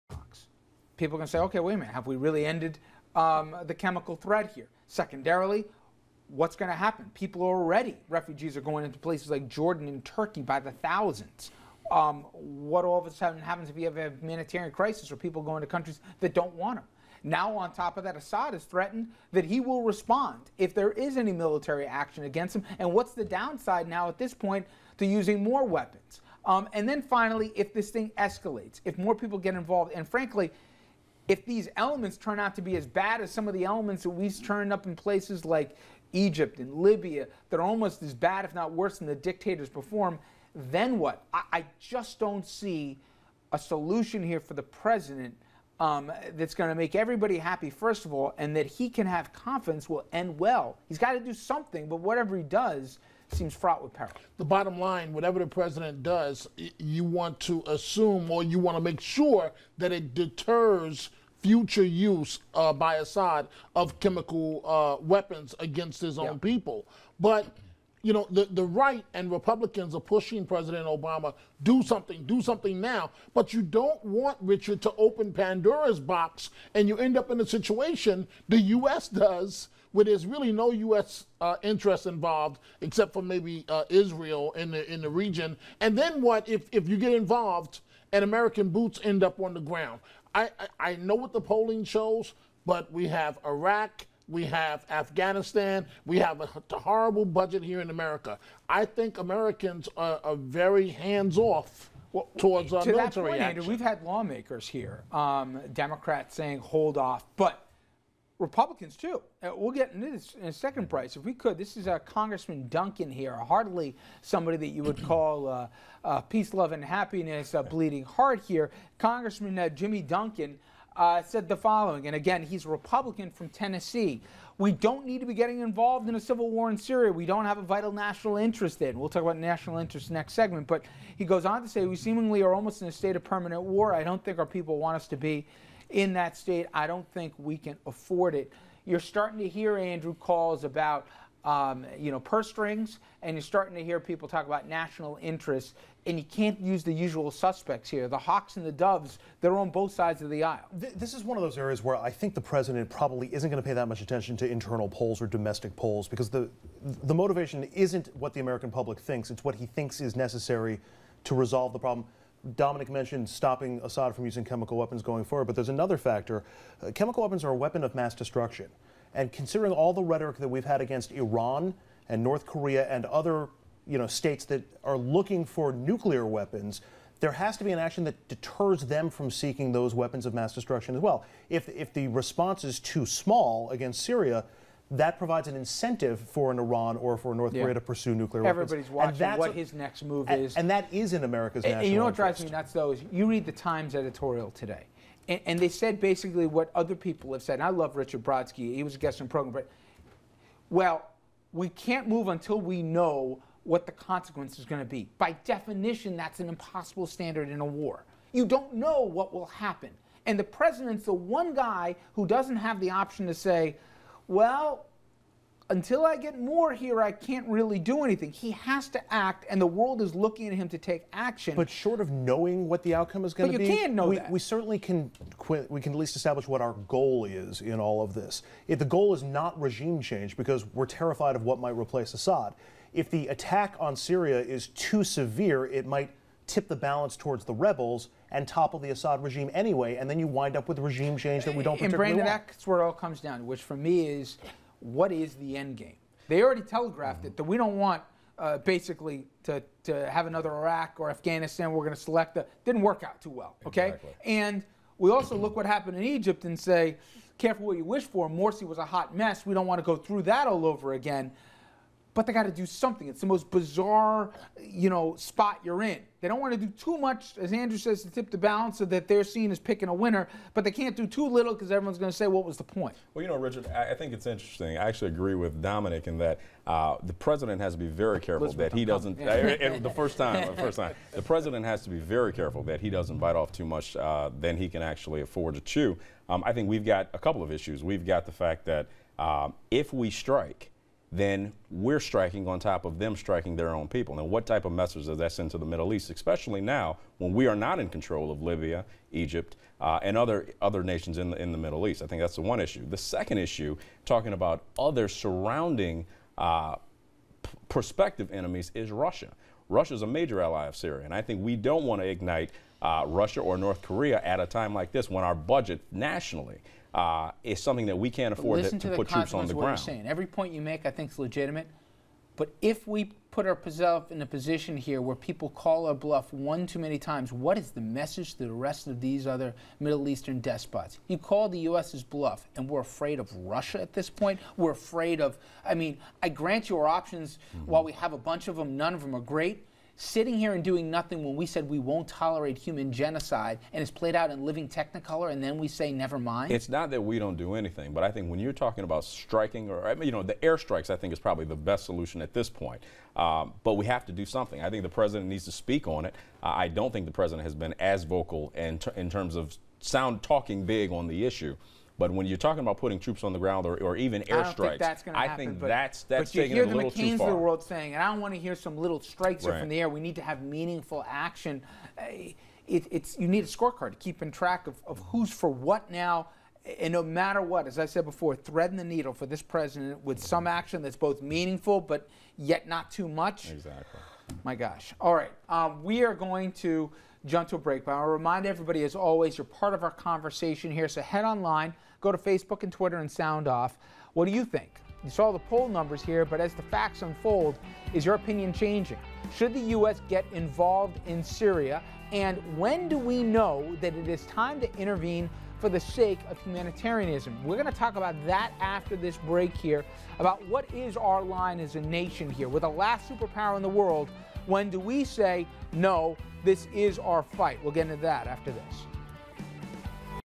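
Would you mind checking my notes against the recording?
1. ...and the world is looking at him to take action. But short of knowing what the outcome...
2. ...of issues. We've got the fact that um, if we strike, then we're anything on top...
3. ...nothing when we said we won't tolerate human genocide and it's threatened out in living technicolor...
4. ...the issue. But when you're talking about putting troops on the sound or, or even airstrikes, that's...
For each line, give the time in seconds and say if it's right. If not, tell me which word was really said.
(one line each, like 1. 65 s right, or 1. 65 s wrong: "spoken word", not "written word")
1. 219 s right
2. 287 s wrong: "striking", not "anything"
3. 340 s wrong: "played", not "threatened"
4. 361 s wrong: "ground", not "sound".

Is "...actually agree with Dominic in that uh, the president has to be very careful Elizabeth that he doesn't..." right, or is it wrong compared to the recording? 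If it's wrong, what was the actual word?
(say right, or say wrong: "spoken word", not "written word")
right.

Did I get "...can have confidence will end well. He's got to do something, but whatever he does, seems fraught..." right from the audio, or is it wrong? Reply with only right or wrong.
right.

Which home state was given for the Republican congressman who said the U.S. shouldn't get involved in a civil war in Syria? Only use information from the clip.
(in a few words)
Tennessee.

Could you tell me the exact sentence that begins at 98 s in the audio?
I think Americans are, are very hands off.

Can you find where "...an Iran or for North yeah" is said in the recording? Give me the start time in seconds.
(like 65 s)
186 s.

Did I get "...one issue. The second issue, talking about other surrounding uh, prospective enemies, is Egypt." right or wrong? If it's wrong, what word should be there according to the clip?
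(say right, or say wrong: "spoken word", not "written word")
wrong: "Russia", not "Egypt".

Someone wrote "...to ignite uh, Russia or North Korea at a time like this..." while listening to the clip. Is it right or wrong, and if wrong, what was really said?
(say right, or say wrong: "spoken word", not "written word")
right.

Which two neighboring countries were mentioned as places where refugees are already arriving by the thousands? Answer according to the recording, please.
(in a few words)
Jordan and Turkey.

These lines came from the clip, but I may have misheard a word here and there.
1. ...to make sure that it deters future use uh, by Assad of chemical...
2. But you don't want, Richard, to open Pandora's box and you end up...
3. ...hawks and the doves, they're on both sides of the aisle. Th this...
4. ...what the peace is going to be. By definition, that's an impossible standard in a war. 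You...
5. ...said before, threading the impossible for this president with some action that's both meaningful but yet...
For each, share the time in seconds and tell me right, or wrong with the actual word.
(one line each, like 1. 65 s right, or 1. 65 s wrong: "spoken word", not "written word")
1. 58 s right
2. 73 s right
3. 148 s right
4. 203 s wrong: "consequence", not "peace"
5. 377 s wrong: "needle", not "impossible".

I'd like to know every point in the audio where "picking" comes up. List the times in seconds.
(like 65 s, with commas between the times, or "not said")
269 s.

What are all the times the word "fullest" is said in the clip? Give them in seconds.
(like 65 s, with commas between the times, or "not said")
not said.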